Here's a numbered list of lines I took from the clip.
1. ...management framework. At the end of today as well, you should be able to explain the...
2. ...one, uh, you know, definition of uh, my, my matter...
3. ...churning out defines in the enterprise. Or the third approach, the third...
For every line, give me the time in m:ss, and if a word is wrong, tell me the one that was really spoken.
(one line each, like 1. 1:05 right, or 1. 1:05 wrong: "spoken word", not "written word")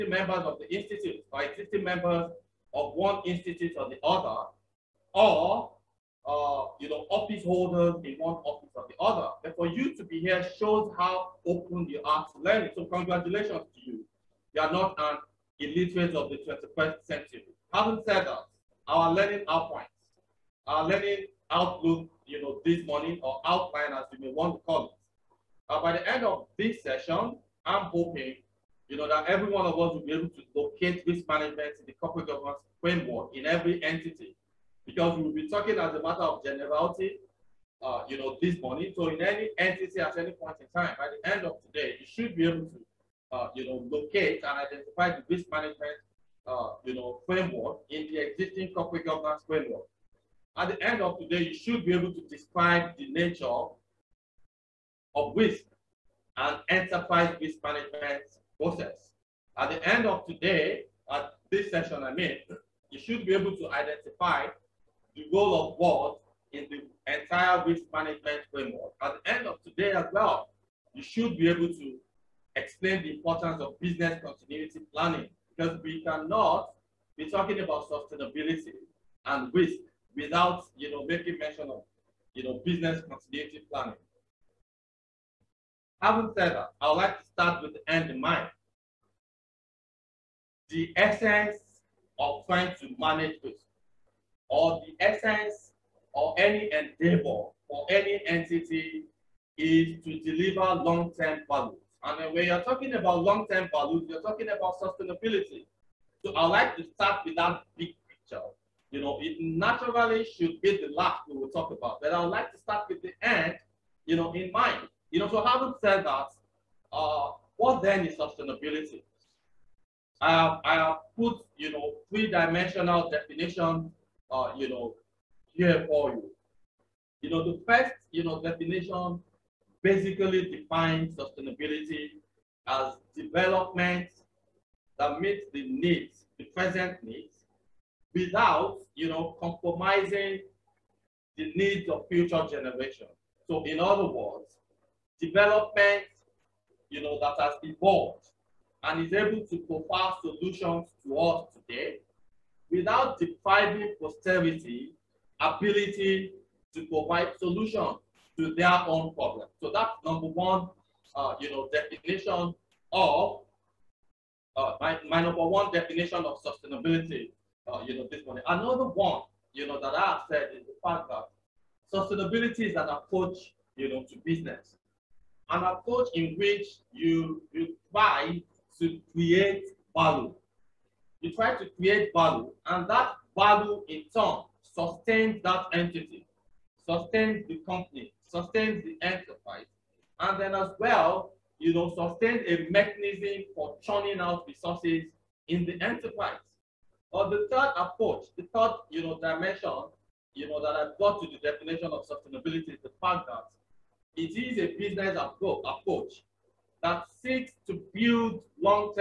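1. 1:07 right
2. 2:40 wrong: "number", not "matter"
3. 3:13 wrong: "resources", not "defines".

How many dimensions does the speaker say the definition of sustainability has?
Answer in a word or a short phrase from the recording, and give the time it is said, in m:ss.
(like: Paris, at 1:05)
3, at 2:02.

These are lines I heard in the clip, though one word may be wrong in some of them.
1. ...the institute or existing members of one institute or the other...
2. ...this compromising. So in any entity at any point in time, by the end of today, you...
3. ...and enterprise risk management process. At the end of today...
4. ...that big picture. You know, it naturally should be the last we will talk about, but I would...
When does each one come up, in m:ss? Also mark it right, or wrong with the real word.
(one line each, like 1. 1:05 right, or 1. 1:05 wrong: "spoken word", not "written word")
1. 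0:00 right
2. 0:38 wrong: "morning", not "compromising"
3. 0:56 right
4. 1:47 right.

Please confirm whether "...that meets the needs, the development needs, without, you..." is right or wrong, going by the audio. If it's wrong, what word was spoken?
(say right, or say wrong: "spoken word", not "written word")
wrong: "present", not "development".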